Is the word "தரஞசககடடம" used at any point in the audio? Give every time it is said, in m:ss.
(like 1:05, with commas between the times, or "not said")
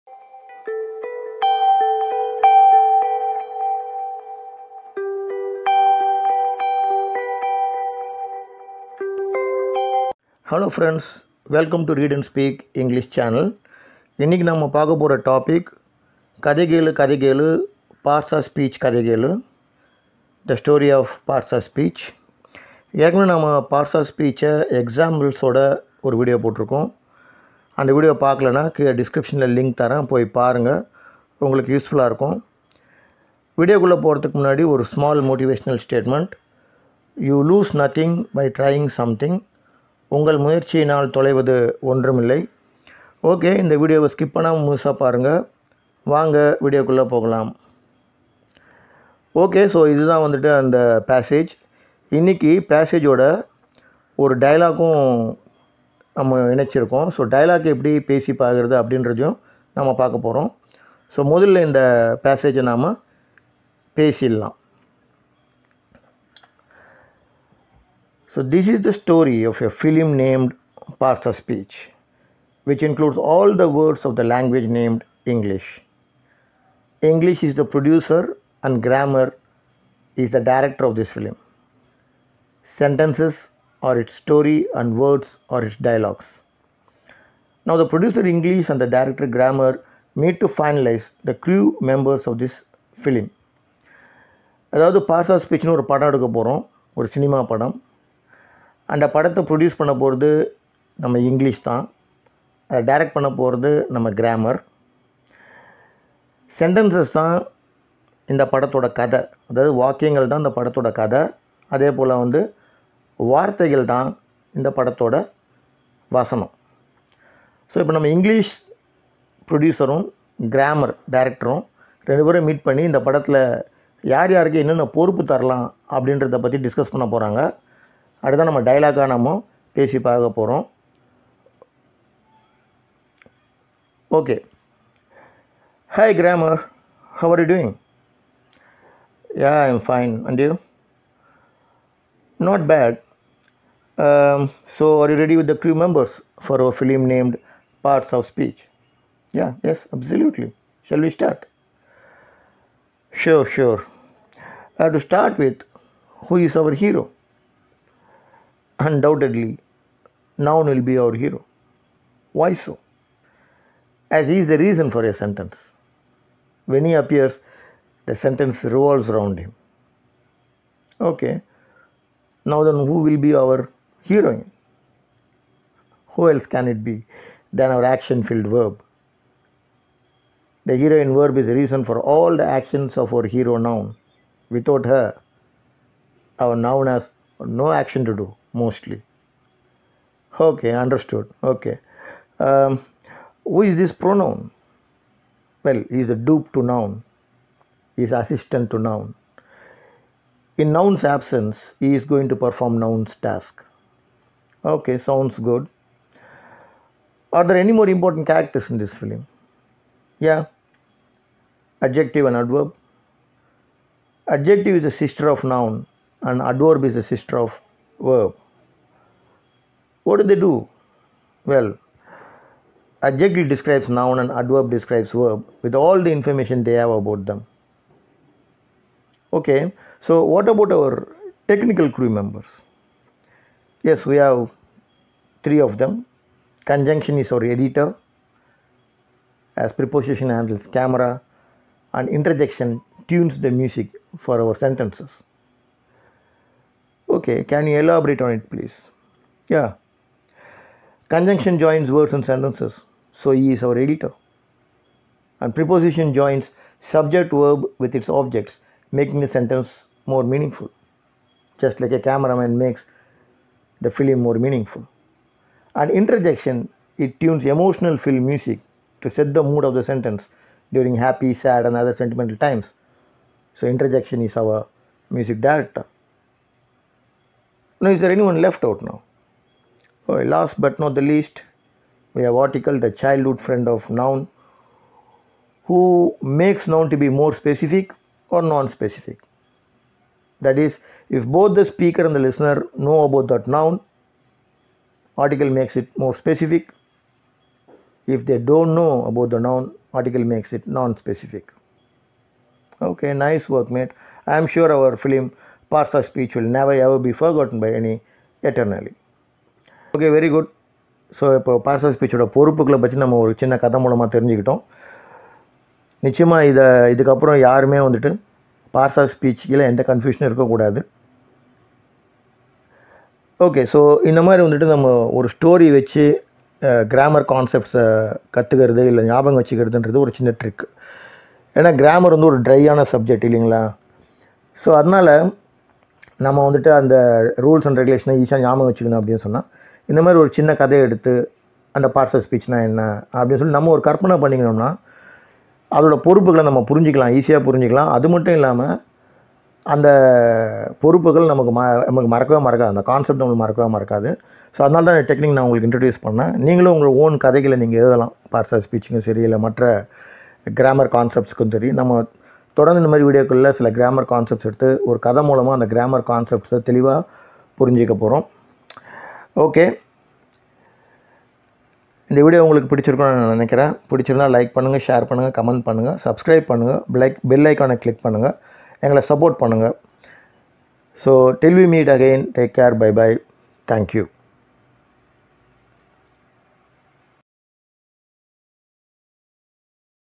5:14.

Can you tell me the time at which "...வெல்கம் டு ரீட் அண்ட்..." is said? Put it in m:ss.
0:11.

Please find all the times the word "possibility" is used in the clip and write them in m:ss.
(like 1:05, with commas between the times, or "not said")
not said.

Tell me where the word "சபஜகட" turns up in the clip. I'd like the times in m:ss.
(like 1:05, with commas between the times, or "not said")
5:32.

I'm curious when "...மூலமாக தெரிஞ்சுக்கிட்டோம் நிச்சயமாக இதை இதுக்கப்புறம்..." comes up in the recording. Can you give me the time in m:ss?
5:13.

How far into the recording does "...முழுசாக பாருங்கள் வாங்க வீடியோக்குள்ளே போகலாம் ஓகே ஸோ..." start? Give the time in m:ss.
0:44.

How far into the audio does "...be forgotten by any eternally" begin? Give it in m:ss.
5:06.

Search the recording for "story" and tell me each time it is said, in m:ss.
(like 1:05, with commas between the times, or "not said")
1:08, 1:24.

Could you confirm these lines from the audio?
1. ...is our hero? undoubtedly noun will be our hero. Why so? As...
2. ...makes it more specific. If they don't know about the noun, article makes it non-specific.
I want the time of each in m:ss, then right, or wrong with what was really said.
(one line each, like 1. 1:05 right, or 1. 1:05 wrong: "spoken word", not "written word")
1. 2:36 right
2. 4:55 right.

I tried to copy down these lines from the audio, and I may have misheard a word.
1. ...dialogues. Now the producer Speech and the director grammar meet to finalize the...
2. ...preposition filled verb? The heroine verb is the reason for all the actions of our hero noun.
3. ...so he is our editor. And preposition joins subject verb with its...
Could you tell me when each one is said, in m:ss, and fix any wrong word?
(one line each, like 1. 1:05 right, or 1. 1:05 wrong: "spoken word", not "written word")
1. 1:25 wrong: "English", not "Speech"
2. 2:57 wrong: "action", not "preposition"
3. 4:13 right.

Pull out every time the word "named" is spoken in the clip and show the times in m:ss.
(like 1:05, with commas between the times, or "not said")
1:10, 1:14, 2:27.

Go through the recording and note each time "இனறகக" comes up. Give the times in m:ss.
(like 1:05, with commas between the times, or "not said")
0:14, 0:52.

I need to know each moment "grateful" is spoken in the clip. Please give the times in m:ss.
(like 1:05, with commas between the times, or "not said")
not said.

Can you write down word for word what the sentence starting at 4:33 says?
So, interjection is our music director.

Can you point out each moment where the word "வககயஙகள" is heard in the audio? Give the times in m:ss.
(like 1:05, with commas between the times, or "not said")
1:49.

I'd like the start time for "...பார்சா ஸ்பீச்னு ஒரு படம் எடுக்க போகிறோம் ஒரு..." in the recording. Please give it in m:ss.
1:35.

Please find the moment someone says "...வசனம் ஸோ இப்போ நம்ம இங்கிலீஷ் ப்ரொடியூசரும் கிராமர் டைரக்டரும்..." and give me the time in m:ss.
1:56.